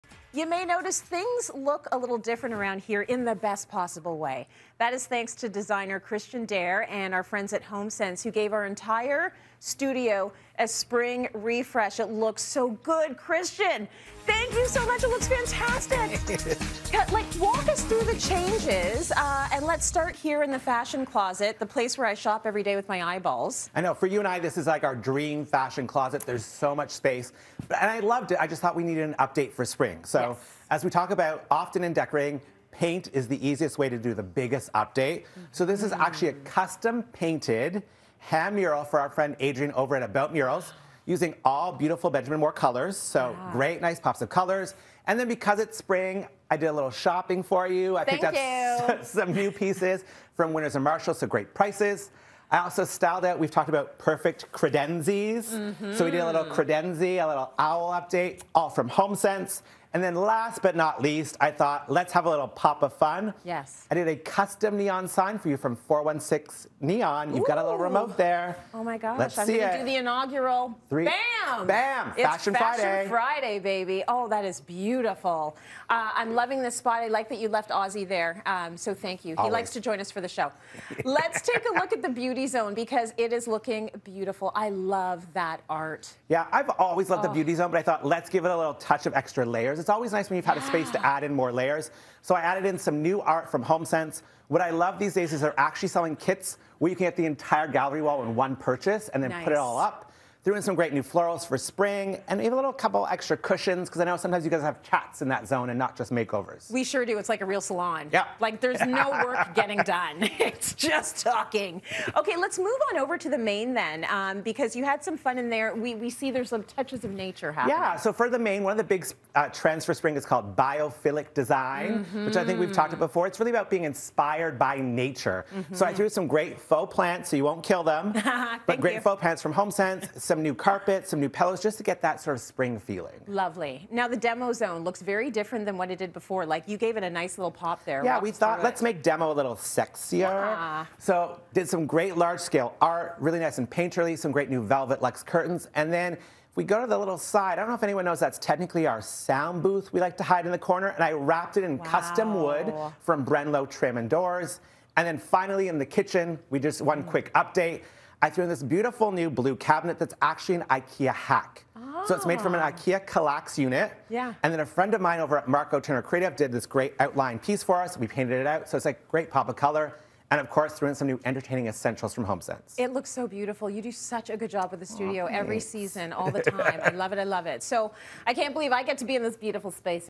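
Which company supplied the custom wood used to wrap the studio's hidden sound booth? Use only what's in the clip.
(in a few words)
Brenlo Trim and Doors.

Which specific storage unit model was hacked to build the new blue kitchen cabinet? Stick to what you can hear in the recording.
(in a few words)
IKEA Kallax.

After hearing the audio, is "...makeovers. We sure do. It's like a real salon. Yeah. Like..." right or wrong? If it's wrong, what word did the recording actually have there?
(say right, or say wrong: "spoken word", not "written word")
right.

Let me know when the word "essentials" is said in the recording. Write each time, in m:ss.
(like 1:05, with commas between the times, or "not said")
2:51.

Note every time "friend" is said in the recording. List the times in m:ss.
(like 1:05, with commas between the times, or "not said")
0:07, 0:39, 2:44.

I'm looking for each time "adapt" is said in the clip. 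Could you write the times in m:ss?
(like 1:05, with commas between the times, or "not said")
not said.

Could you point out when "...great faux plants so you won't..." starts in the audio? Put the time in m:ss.
2:06.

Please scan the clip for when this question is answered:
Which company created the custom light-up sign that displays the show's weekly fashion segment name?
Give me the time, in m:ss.
1:05.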